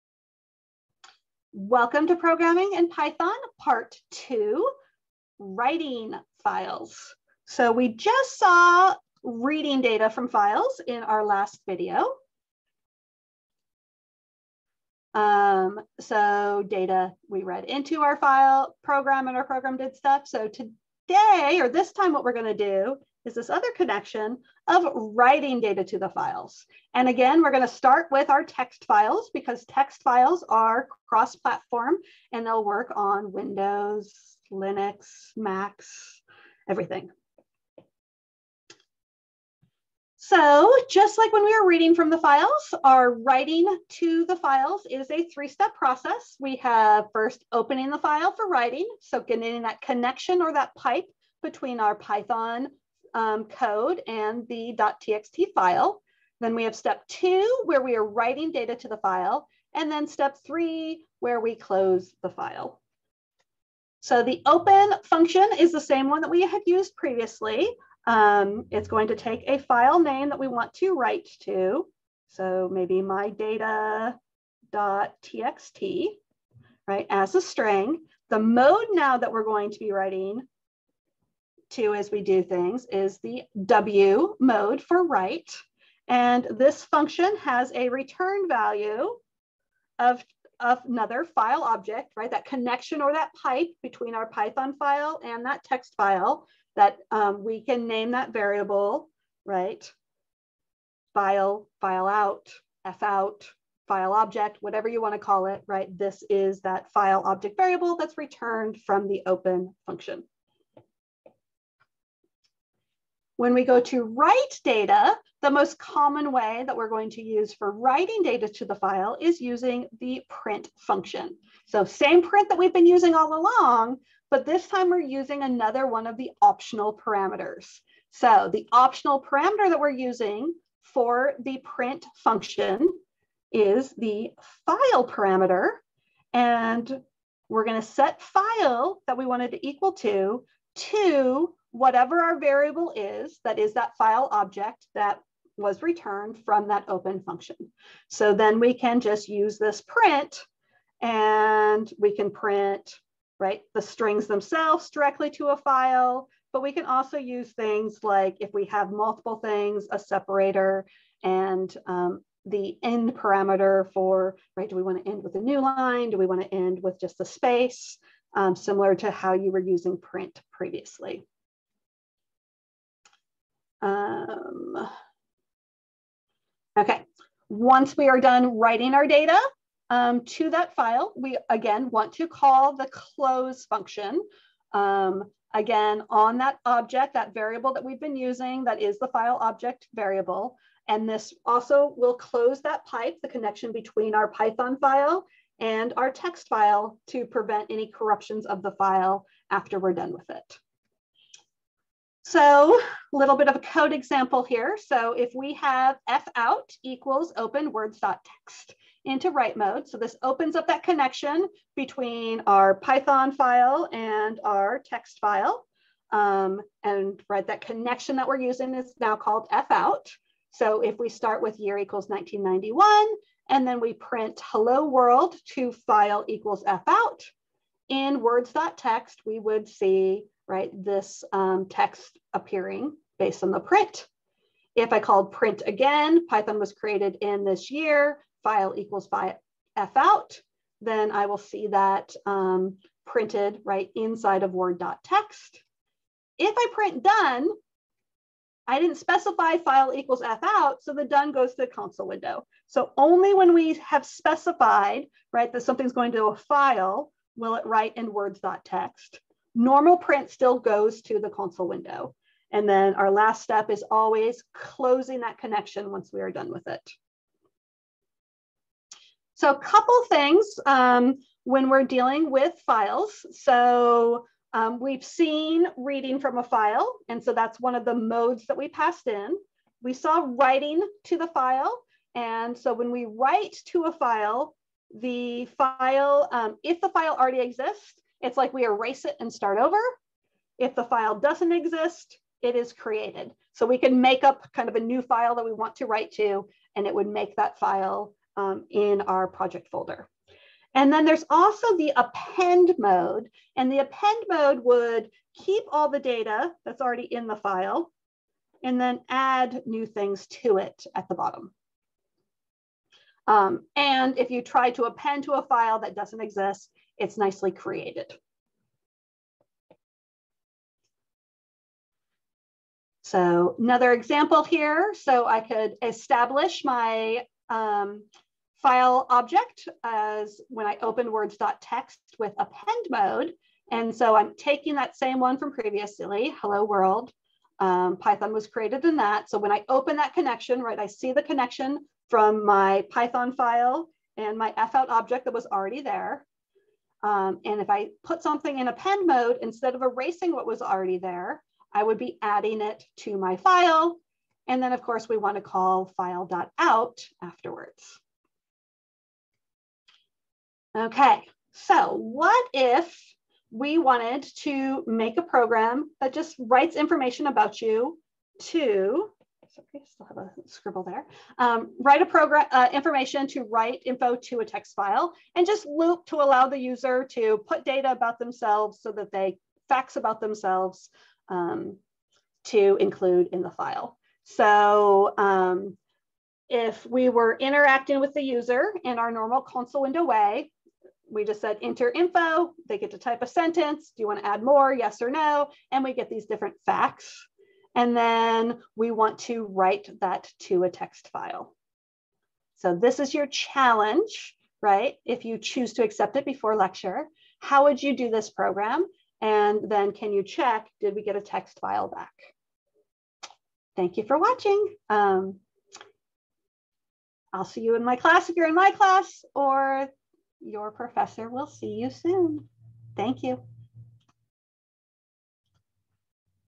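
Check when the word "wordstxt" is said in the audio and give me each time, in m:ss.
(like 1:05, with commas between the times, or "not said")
3:27, 3:48, 5:31.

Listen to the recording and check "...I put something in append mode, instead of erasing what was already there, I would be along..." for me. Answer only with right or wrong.
wrong.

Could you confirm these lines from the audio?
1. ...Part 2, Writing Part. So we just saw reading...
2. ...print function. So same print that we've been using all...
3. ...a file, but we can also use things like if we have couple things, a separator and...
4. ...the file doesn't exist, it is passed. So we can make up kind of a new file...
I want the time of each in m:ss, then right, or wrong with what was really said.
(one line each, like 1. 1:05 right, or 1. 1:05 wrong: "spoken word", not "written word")
1. 0:03 wrong: "Files", not "Part"
2. 2:00 right
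3. 2:35 wrong: "multiple", not "couple"
4. 4:50 wrong: "created", not "passed".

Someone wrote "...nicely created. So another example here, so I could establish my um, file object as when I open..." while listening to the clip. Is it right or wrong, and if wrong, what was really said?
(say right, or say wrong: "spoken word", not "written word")
right.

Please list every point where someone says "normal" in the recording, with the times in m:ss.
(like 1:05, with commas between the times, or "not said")
4:19, 6:29.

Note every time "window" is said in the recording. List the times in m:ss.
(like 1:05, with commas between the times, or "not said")
0:33, 4:12, 4:21, 6:29.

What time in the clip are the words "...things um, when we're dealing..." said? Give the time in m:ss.
4:30.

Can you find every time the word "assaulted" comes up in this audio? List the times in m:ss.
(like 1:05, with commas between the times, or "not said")
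not said.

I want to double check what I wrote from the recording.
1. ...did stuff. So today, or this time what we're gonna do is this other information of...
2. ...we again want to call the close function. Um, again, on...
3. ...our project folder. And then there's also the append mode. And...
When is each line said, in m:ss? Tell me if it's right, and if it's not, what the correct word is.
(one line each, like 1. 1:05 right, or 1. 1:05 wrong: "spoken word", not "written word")
1. 0:19 wrong: "connection", not "information"
2. 3:01 right
3. 4:59 right.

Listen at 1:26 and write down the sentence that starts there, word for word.
And this function has a return value of, of another file object, right?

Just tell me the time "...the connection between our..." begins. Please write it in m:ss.
3:13.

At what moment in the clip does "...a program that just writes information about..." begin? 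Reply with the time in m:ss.
6:05.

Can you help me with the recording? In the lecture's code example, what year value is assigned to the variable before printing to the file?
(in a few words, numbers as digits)
1991.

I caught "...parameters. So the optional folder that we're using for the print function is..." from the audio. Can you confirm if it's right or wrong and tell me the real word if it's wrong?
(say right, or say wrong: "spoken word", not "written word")
wrong: "parameter", not "folder".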